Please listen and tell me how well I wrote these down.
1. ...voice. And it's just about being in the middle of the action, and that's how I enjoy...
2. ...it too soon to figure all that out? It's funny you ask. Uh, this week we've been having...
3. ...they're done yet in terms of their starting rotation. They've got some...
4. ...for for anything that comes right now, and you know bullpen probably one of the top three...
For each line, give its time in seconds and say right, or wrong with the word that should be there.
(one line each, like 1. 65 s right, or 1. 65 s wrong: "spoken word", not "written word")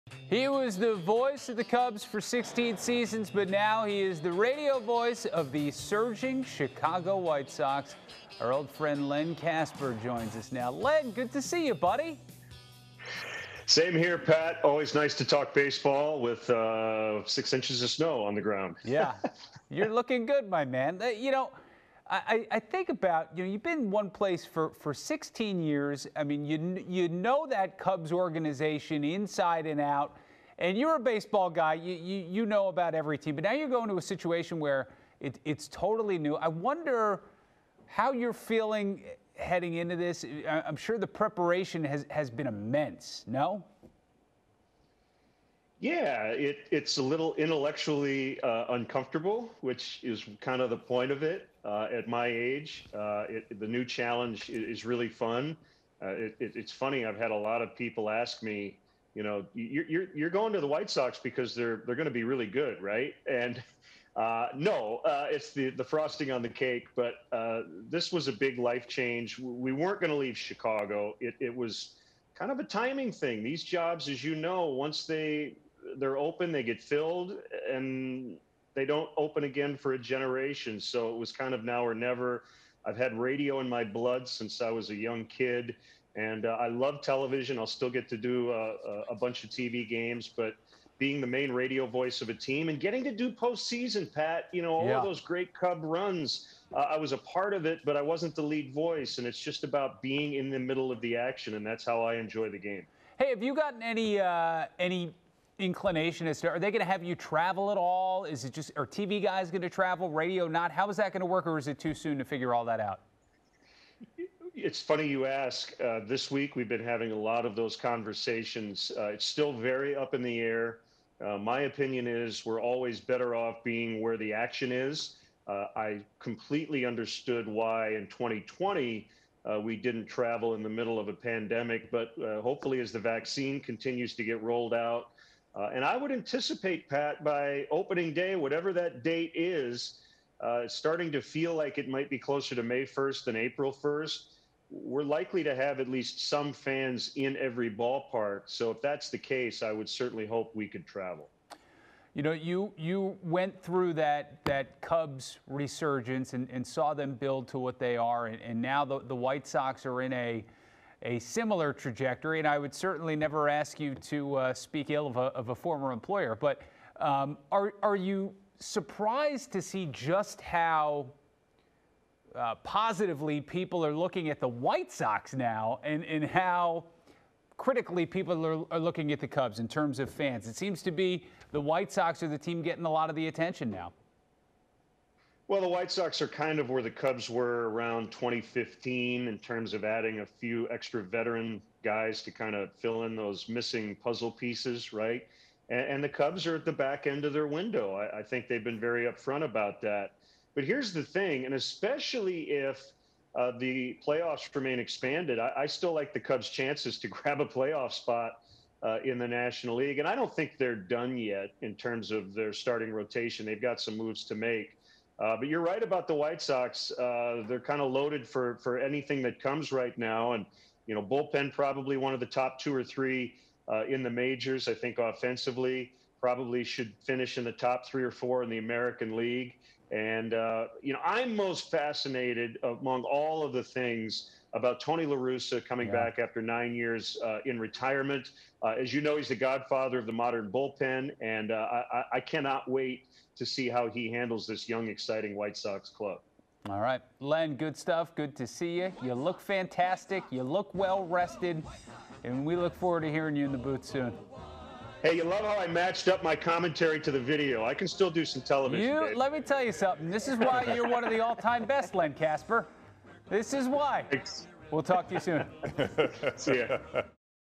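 1. 98 s right
2. 111 s right
3. 210 s right
4. 218 s wrong: "two", not "three".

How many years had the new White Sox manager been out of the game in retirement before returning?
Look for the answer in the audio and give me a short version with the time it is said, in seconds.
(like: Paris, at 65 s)
9, at 236 s.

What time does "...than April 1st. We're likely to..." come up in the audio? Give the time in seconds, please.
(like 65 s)
143 s.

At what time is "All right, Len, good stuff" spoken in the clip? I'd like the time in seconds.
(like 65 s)
246 s.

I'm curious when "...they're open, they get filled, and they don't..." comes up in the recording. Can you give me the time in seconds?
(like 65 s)
75 s.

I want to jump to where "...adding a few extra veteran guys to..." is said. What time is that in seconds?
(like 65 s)
189 s.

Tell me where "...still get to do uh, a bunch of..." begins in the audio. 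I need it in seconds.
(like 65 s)
87 s.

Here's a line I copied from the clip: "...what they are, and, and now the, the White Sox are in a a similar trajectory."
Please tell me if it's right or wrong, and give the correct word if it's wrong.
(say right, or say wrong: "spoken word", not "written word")
right.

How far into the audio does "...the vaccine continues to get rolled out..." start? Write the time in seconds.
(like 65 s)
132 s.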